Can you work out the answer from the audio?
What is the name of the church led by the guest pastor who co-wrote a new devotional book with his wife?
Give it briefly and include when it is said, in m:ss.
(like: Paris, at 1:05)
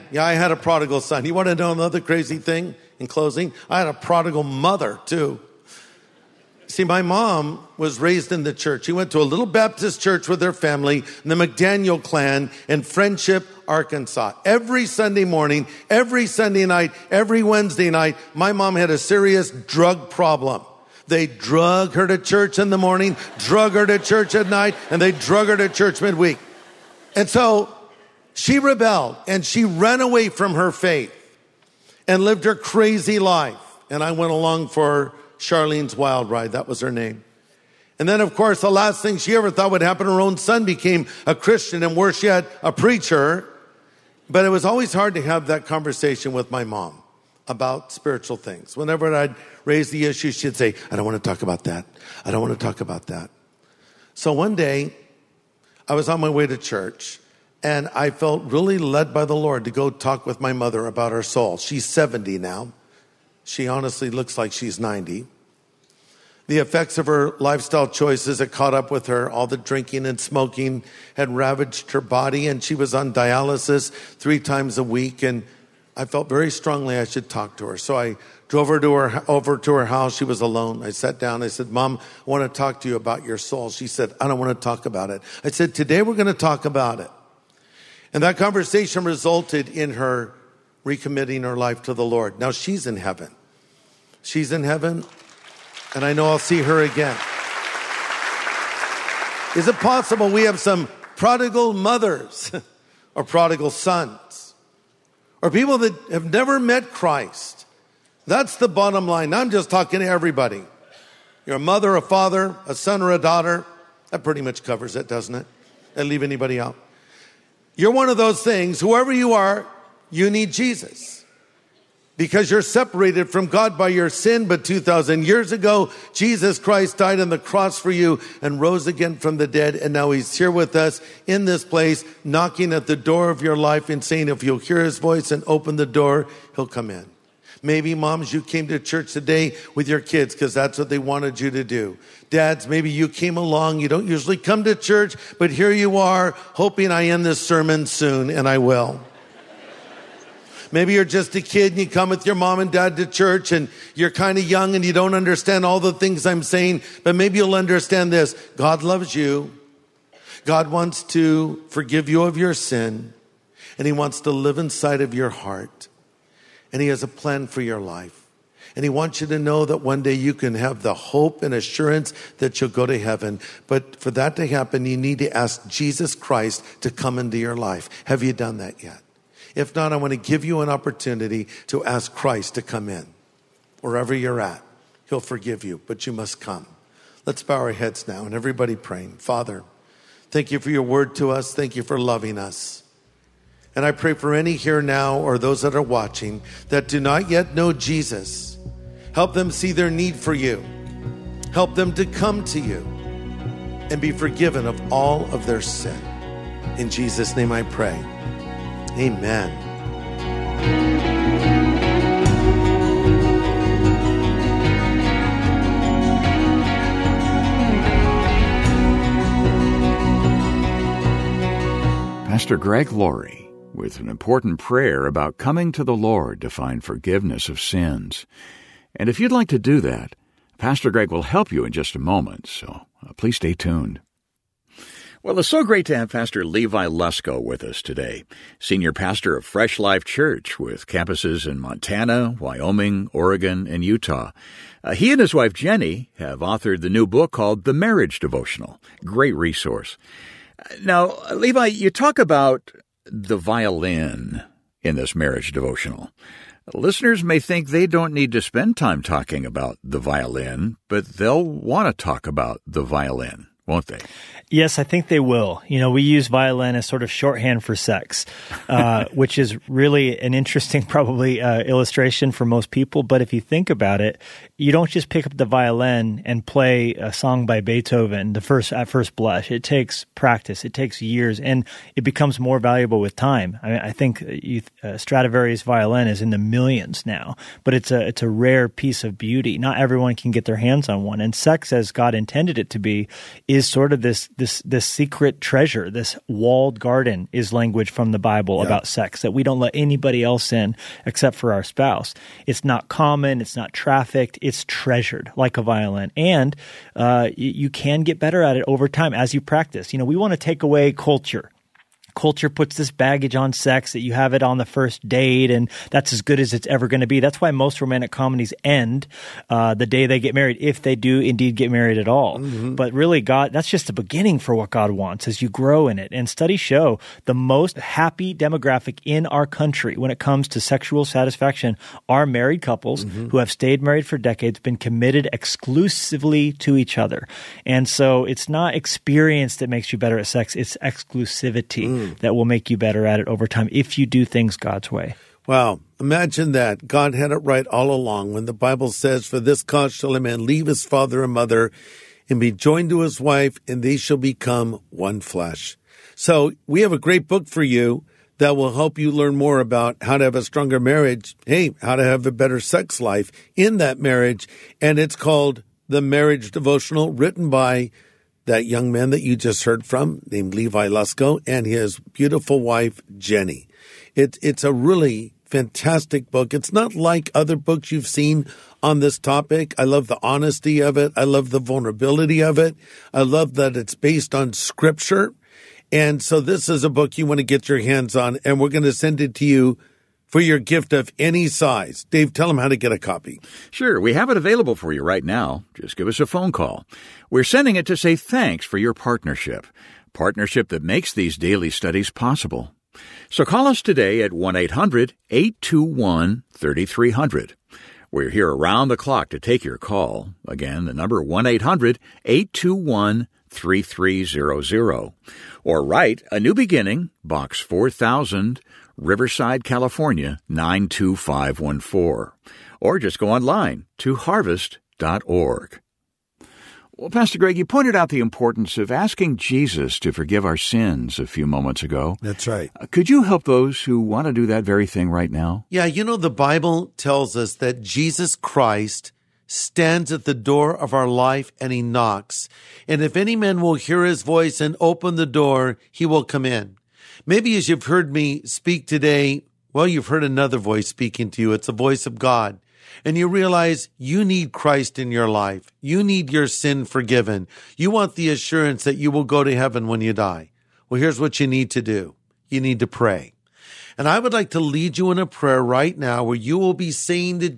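Fresh Life Church, at 3:59.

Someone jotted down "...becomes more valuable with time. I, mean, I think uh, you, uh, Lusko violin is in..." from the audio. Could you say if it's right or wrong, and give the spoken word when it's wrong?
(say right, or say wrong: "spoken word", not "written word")
wrong: "Stradivarius", not "Lusko".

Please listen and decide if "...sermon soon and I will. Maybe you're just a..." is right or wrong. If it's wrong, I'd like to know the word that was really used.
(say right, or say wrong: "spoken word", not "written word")
right.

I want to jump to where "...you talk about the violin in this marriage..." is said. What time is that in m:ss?
4:11.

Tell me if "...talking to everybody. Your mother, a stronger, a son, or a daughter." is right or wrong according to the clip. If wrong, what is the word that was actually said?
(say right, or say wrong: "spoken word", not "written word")
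wrong: "father", not "stronger".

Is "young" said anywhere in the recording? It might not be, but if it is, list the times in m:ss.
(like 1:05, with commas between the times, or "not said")
2:34, 6:08.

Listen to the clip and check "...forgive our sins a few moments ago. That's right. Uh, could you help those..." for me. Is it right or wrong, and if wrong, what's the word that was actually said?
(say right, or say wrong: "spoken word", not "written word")
right.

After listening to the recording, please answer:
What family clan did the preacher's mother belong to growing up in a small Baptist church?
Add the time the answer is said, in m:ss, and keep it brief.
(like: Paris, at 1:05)
McDaniel, at 0:11.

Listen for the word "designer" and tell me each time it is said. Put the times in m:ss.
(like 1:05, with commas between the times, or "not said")
not said.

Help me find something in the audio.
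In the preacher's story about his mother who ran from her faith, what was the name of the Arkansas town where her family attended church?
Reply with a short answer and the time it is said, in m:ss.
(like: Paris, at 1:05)
Friendship, at 0:12.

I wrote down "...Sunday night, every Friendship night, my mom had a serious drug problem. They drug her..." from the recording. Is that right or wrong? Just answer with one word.
wrong.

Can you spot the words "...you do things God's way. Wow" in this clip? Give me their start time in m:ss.
5:43.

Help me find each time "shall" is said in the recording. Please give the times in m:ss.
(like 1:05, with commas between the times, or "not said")
5:49, 5:53.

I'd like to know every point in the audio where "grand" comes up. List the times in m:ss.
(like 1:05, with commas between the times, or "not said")
not said.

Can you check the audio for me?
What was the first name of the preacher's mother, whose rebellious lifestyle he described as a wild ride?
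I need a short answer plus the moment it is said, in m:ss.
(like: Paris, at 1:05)
Charlene, at 0:35.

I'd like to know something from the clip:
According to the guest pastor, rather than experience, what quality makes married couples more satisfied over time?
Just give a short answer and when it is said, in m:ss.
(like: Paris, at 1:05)
exclusivity, at 5:40.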